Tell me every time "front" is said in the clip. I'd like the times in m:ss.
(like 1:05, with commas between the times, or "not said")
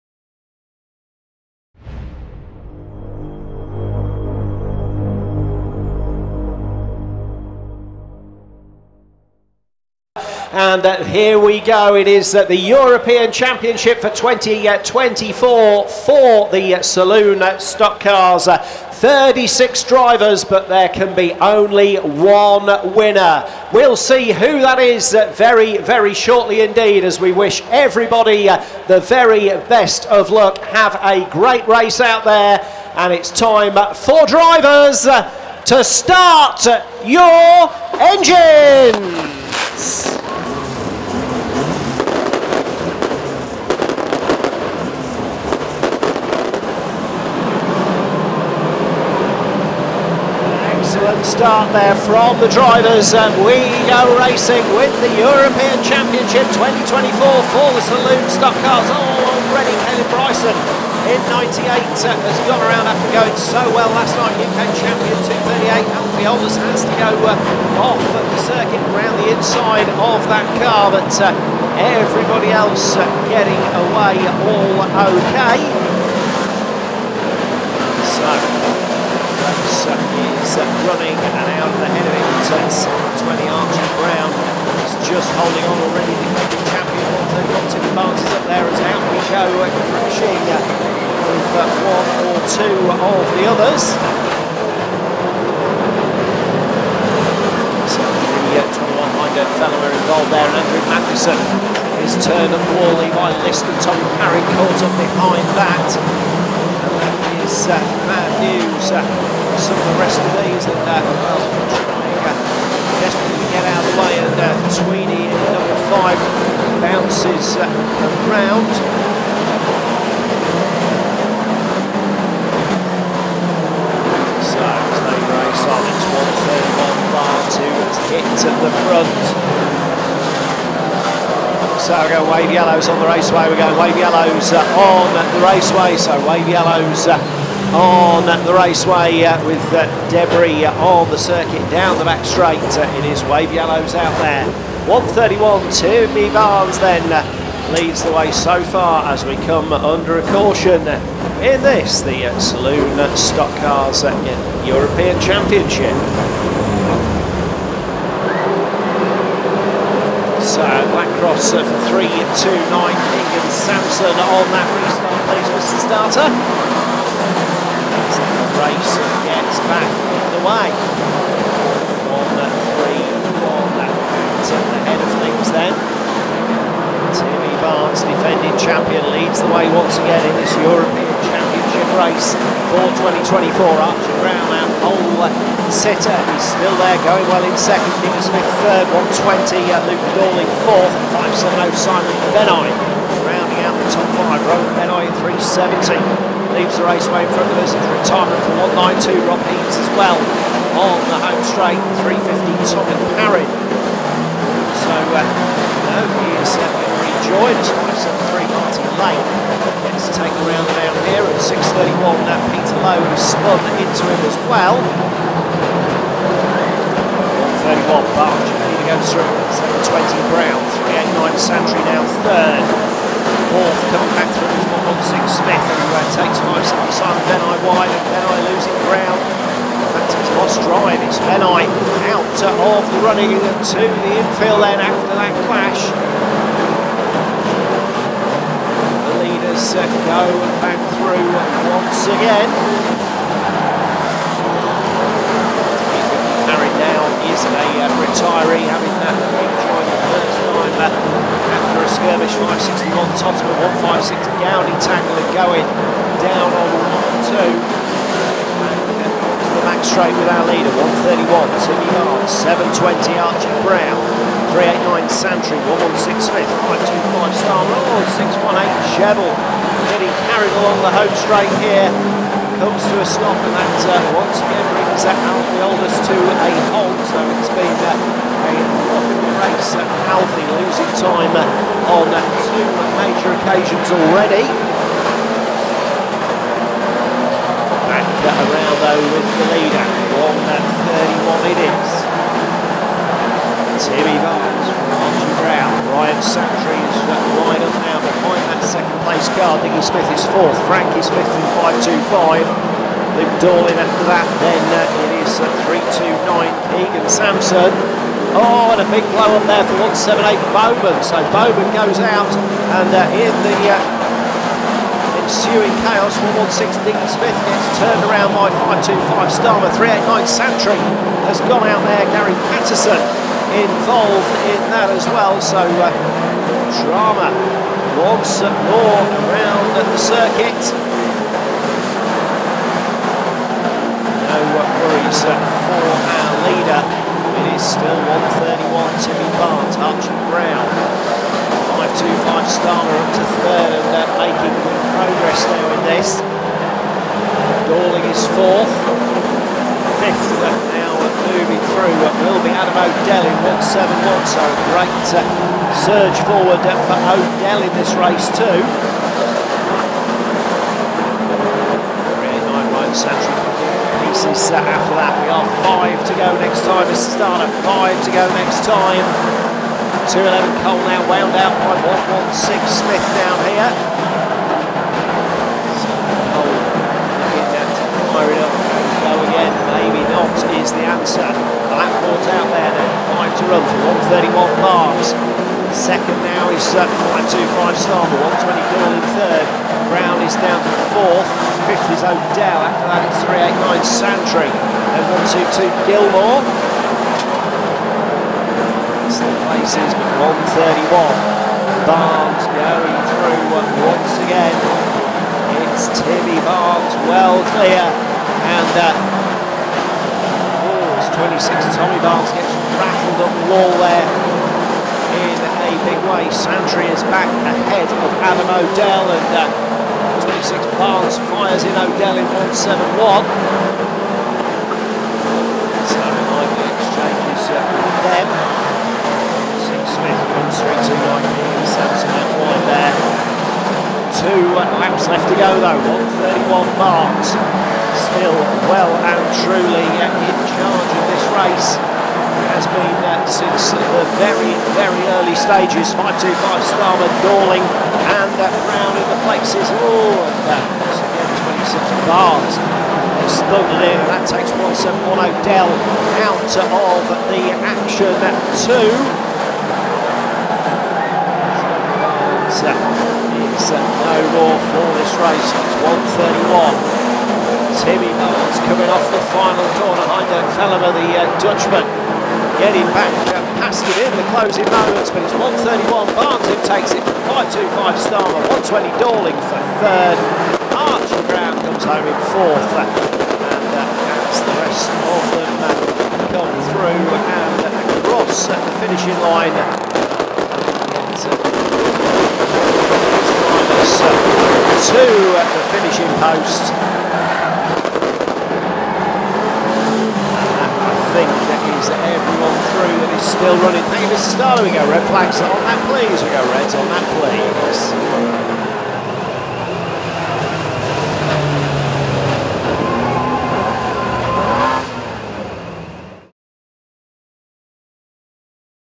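2:08, 3:17.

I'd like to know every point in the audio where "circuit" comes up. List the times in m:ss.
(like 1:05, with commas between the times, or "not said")
1:08, 2:21, 5:29.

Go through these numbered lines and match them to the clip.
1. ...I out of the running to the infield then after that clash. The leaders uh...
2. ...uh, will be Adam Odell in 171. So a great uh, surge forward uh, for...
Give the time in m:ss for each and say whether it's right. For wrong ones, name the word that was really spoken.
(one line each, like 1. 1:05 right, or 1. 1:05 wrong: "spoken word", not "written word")
1. 3:51 right
2. 5:52 right.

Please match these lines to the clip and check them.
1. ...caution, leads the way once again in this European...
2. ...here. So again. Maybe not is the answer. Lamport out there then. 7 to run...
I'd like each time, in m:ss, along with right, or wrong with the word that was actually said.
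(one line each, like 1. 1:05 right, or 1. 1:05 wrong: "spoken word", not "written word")
1. 2:58 wrong: "champion", not "caution"
2. 6:13 wrong: "5", not "7".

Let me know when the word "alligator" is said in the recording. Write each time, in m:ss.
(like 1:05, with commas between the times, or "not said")
not said.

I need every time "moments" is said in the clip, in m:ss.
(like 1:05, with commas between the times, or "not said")
7:54.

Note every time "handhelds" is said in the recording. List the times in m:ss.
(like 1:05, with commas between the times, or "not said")
not said.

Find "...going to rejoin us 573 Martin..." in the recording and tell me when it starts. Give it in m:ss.
3:26.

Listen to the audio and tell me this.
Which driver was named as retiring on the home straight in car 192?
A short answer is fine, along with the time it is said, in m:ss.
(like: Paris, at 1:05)
Rob Eames, at 3:19.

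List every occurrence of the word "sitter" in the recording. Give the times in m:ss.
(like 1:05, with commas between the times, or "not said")
3:05.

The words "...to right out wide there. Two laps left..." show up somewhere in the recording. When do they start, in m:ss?
7:10.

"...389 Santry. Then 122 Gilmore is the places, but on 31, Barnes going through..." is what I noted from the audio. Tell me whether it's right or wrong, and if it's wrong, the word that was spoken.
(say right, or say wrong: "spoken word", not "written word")
right.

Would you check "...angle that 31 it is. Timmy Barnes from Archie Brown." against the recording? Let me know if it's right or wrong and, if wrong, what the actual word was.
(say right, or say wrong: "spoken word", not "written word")
right.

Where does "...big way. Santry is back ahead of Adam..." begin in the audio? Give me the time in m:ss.
6:55.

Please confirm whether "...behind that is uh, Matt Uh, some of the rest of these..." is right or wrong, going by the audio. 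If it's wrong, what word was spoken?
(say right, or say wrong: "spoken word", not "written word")
right.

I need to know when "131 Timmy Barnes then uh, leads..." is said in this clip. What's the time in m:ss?
2:24.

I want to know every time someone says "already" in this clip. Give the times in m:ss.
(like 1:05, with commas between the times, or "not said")
0:59, 1:25, 4:43.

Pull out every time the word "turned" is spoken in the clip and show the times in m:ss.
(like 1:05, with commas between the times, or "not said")
1:42, 5:17.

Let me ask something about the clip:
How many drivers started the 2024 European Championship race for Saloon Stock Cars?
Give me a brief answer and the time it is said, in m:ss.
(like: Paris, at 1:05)
36, at 0:18.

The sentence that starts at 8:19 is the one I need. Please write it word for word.
And I think that is everyone through that is still running.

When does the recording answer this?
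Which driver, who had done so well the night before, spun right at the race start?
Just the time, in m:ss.
0:59.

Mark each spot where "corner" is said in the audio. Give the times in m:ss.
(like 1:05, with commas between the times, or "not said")
2:52, 7:49.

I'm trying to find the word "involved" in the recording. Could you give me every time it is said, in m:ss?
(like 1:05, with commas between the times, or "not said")
1:39, 5:23.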